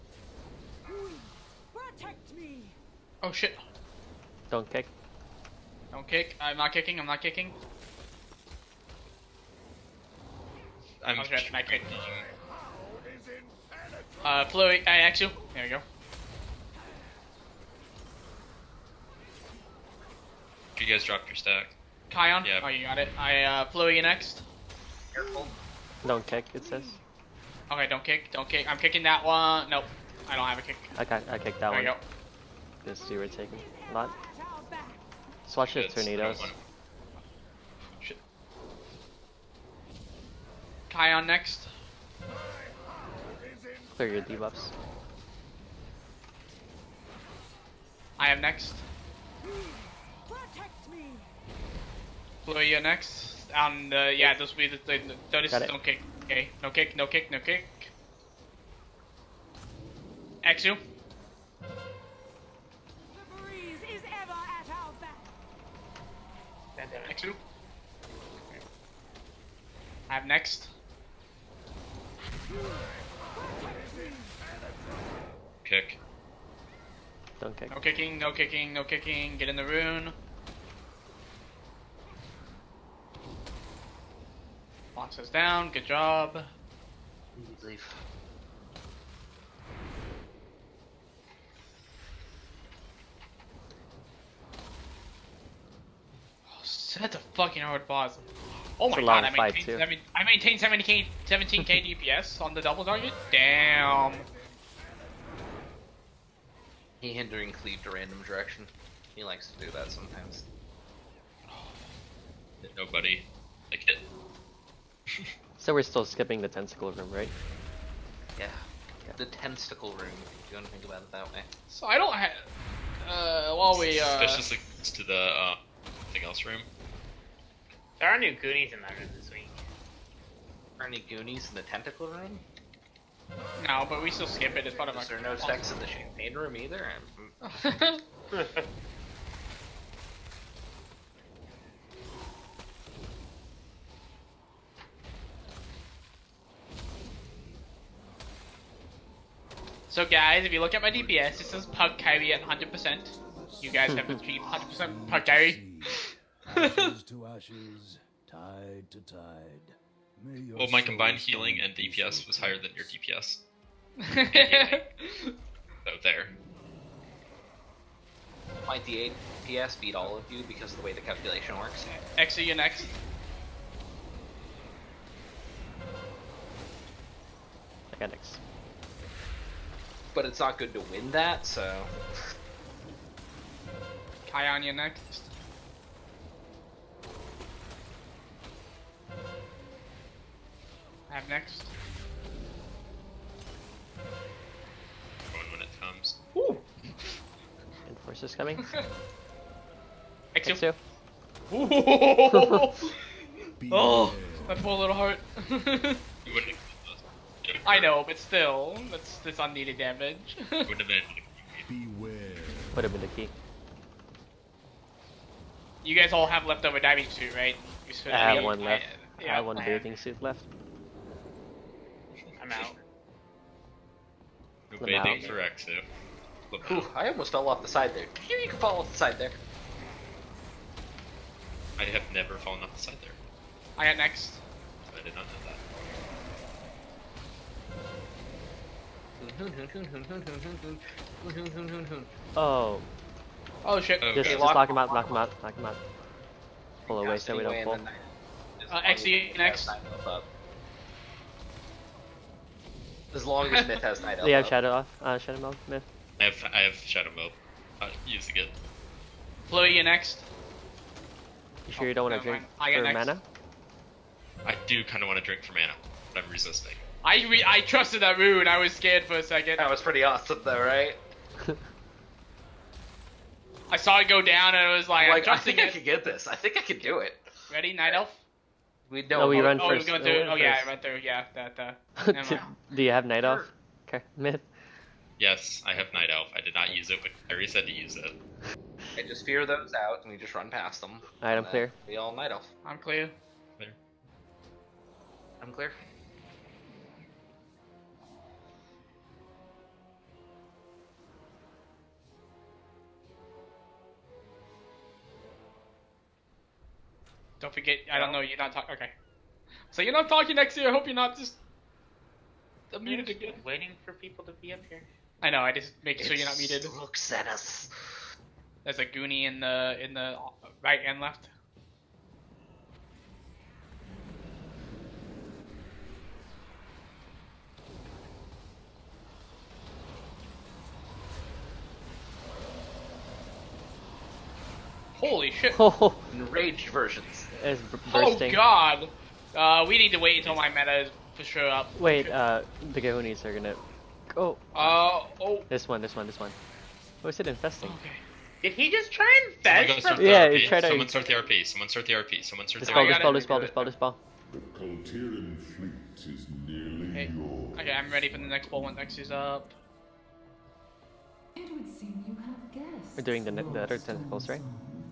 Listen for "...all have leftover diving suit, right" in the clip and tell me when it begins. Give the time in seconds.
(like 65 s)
216 s.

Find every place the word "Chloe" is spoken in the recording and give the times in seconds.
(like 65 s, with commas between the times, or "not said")
14 s, 259 s.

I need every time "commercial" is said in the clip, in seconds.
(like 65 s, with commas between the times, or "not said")
not said.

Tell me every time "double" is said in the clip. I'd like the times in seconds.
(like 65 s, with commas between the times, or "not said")
102 s.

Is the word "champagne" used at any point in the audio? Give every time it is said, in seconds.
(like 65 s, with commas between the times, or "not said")
135 s.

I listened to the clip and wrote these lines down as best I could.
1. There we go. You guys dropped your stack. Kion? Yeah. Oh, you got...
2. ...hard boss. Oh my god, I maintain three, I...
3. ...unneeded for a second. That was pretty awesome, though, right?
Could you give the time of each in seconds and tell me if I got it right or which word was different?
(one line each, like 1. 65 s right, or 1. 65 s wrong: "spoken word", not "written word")
1. 15 s right
2. 97 s wrong: "seven", not "three"
3. 268 s wrong: "scared", not "unneeded".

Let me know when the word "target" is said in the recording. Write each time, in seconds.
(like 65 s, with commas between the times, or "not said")
102 s.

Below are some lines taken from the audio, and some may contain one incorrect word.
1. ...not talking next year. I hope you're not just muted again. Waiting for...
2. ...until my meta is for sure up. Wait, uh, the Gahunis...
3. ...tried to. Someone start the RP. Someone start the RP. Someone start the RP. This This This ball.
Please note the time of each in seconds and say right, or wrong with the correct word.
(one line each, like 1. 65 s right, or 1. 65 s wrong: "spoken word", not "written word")
1. 309 s right
2. 340 s right
3. 350 s right.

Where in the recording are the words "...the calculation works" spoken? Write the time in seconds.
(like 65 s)
170 s.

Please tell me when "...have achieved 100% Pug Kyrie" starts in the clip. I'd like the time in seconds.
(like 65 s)
153 s.